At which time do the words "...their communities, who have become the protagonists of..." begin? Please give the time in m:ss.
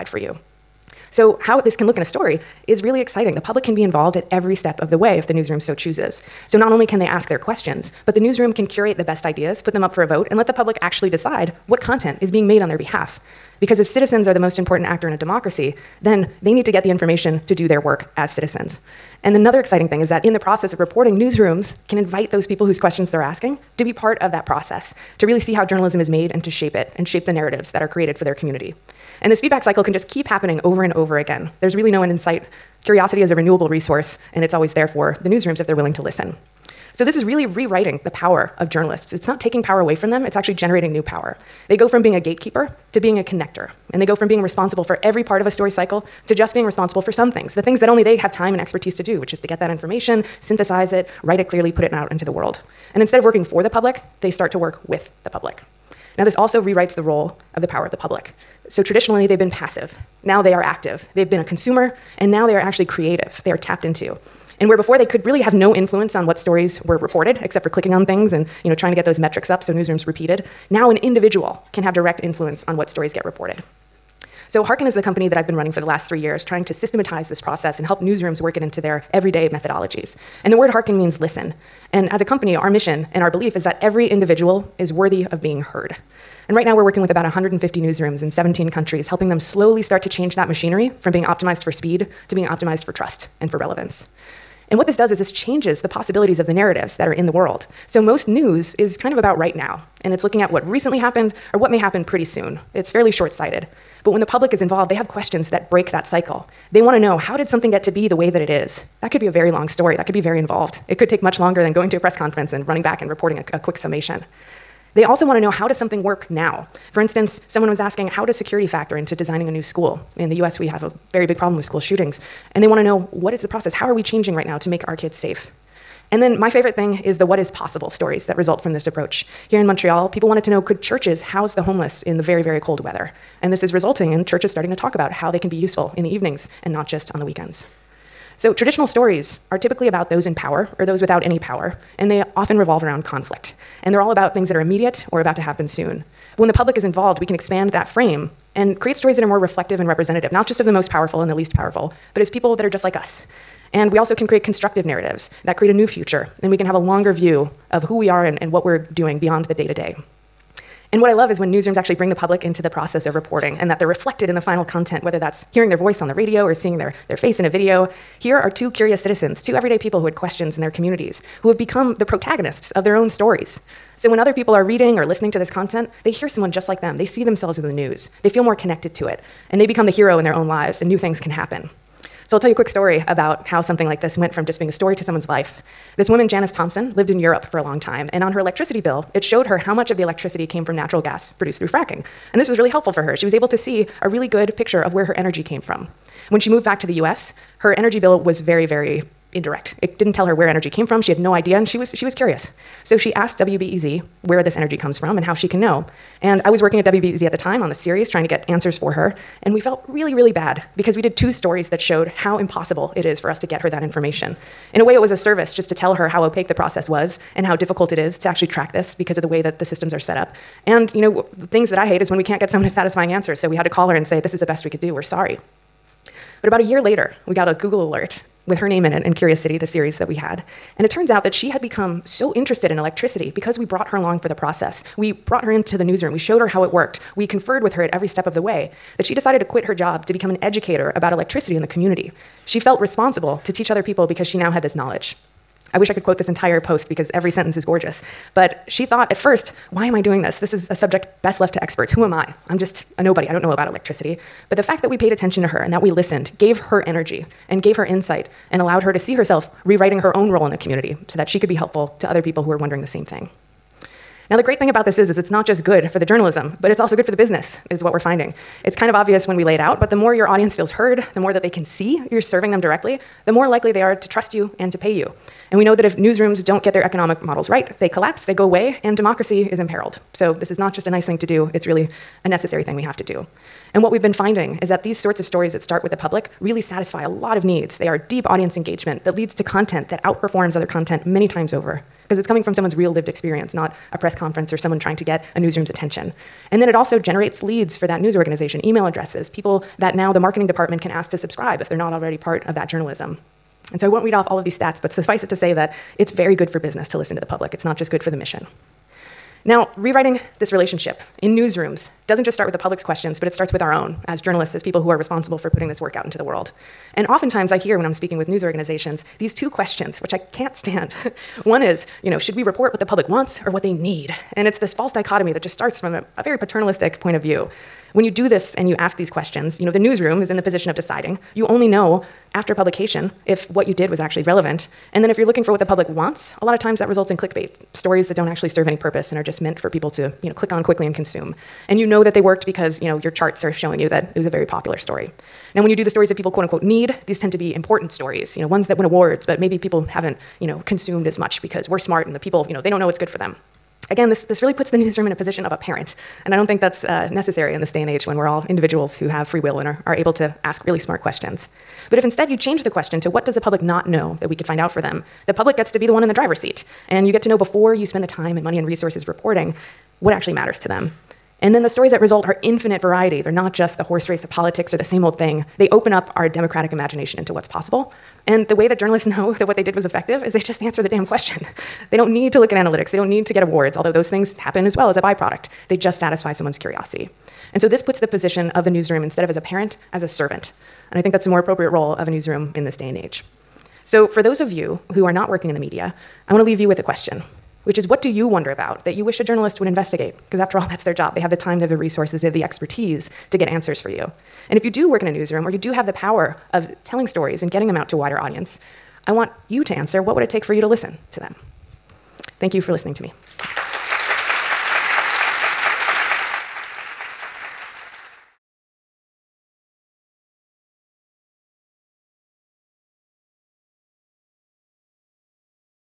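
2:50.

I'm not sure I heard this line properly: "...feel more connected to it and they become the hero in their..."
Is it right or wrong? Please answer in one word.
right.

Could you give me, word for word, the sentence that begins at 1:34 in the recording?
And what this does is this changes the possibilities of the narratives that are in the world.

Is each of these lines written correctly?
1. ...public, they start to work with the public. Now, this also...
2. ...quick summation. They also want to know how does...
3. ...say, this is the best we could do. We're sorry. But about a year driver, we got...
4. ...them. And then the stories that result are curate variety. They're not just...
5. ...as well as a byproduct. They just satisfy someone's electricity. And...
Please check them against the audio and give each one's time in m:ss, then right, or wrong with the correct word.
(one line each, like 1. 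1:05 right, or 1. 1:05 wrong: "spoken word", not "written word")
1. 0:53 right
2. 1:53 right
3. 3:44 wrong: "later", not "driver"
4. 6:10 wrong: "infinite", not "curate"
5. 6:24 wrong: "curiosity", not "electricity".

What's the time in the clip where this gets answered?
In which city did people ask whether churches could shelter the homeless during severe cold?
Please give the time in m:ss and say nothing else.
2:09.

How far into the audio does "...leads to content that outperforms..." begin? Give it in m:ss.
4:49.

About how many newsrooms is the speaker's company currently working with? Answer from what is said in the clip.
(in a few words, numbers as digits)
150.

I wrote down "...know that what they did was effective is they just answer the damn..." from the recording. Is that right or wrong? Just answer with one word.
right.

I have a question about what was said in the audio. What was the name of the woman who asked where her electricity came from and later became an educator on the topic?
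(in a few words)
Janice Thompson.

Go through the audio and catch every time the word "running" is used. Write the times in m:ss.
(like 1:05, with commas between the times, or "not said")
1:15, 1:52.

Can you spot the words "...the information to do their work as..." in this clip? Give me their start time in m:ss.
0:16.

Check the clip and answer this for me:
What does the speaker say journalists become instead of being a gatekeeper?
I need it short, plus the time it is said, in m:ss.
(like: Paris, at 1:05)
A connector, at 0:43.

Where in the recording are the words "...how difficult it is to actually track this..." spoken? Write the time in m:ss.
3:37.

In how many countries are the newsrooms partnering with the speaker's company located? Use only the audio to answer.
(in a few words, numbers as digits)
17.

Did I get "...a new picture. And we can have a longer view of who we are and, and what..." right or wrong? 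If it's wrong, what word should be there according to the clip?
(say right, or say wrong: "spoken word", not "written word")
wrong: "future", not "picture".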